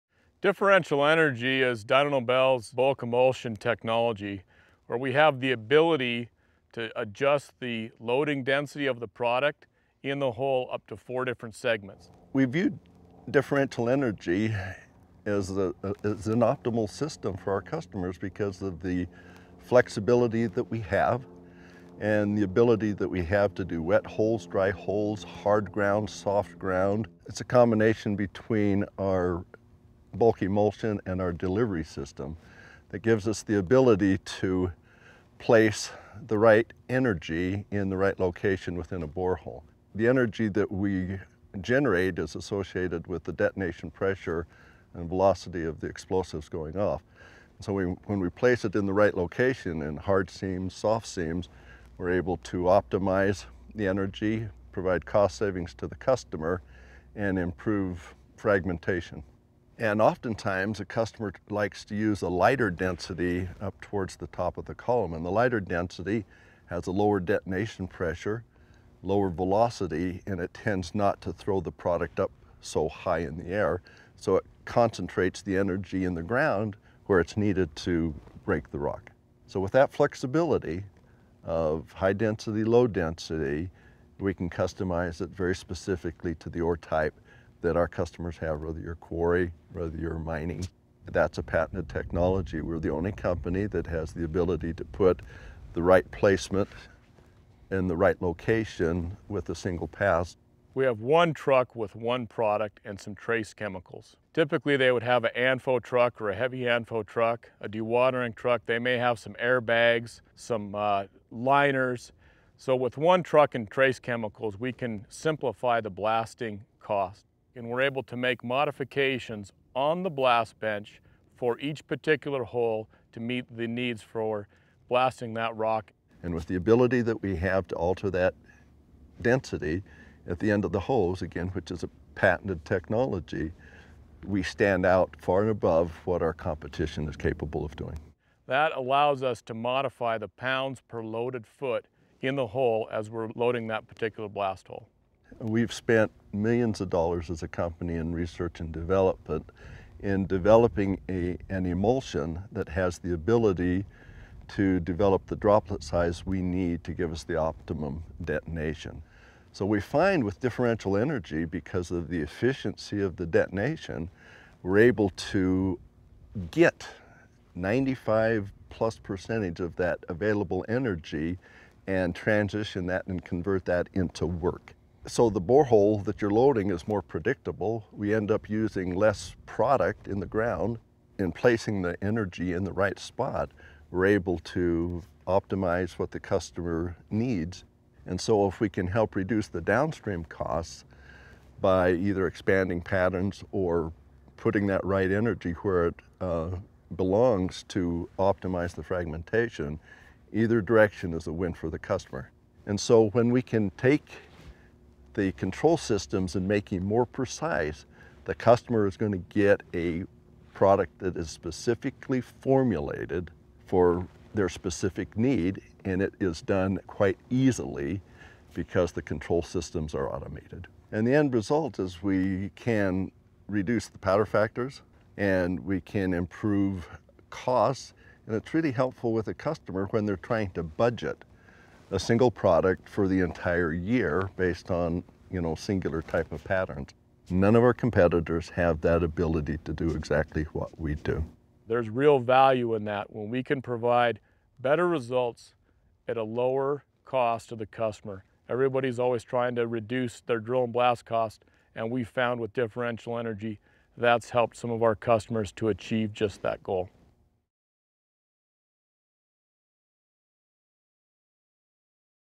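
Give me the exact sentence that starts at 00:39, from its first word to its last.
The energy that we generate is associated with the detonation pressure and velocity of the explosives going off.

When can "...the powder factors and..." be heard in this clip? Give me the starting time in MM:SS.
03:43.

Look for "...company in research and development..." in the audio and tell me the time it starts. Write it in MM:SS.
02:27.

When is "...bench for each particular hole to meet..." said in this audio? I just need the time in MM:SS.
02:00.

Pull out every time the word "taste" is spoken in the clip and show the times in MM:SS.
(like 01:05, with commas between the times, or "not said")
not said.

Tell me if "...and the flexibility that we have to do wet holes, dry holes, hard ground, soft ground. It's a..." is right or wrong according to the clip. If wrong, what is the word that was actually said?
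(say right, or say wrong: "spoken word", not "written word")
wrong: "ability", not "flexibility".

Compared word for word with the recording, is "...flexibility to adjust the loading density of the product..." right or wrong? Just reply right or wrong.
wrong.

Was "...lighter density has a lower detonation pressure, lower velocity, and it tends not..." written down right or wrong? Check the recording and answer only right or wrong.
right.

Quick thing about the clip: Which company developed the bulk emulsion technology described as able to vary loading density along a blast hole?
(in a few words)
Dyno Nobel.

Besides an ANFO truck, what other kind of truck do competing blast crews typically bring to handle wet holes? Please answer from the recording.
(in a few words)
Dewatering truck.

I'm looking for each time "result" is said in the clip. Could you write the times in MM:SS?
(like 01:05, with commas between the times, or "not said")
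03:41, 04:04.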